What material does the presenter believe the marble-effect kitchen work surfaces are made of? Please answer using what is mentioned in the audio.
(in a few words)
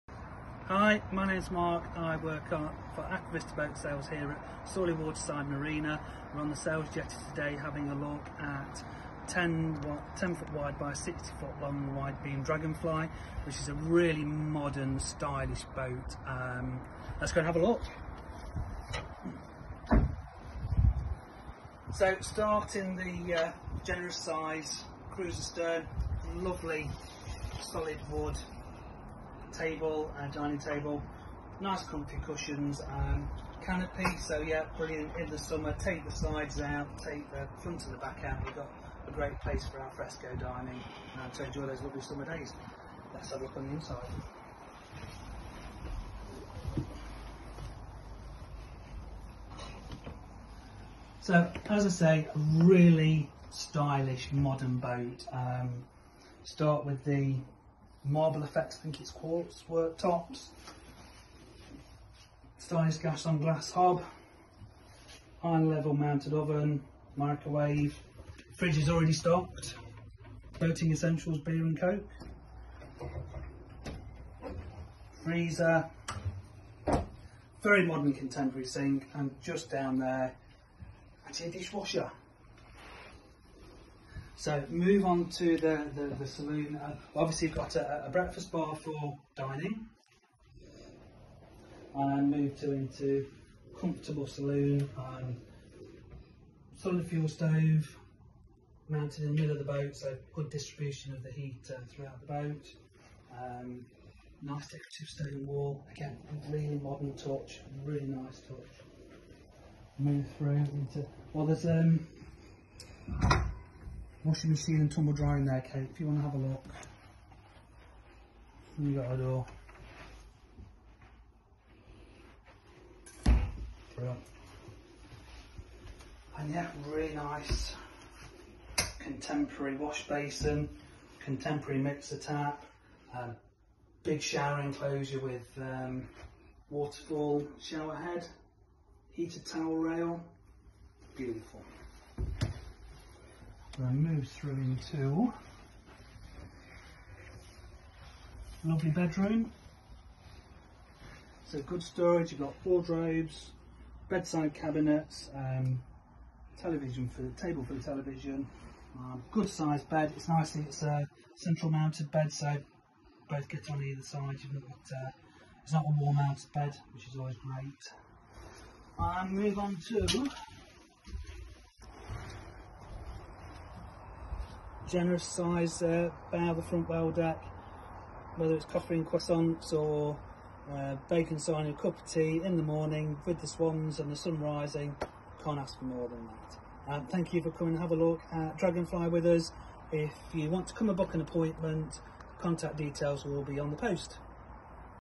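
Quartz.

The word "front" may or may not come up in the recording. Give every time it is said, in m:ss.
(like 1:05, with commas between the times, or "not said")
0:37, 2:56.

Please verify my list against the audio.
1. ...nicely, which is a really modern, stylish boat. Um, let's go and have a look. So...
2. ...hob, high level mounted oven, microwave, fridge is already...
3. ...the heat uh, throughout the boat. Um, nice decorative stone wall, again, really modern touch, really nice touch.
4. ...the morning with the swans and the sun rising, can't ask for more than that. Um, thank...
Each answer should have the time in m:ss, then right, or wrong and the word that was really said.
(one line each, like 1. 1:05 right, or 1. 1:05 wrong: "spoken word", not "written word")
1. 0:12 wrong: "dragonfly", not "nicely"
2. 1:03 right
3. 1:41 right
4. 3:02 right.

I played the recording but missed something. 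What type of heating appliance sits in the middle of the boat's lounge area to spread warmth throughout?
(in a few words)
Solid fuel stove.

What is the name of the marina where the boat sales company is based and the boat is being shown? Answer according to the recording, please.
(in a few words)
Sawley Waterside Marina.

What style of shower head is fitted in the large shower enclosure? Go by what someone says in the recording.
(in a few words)
Waterfall.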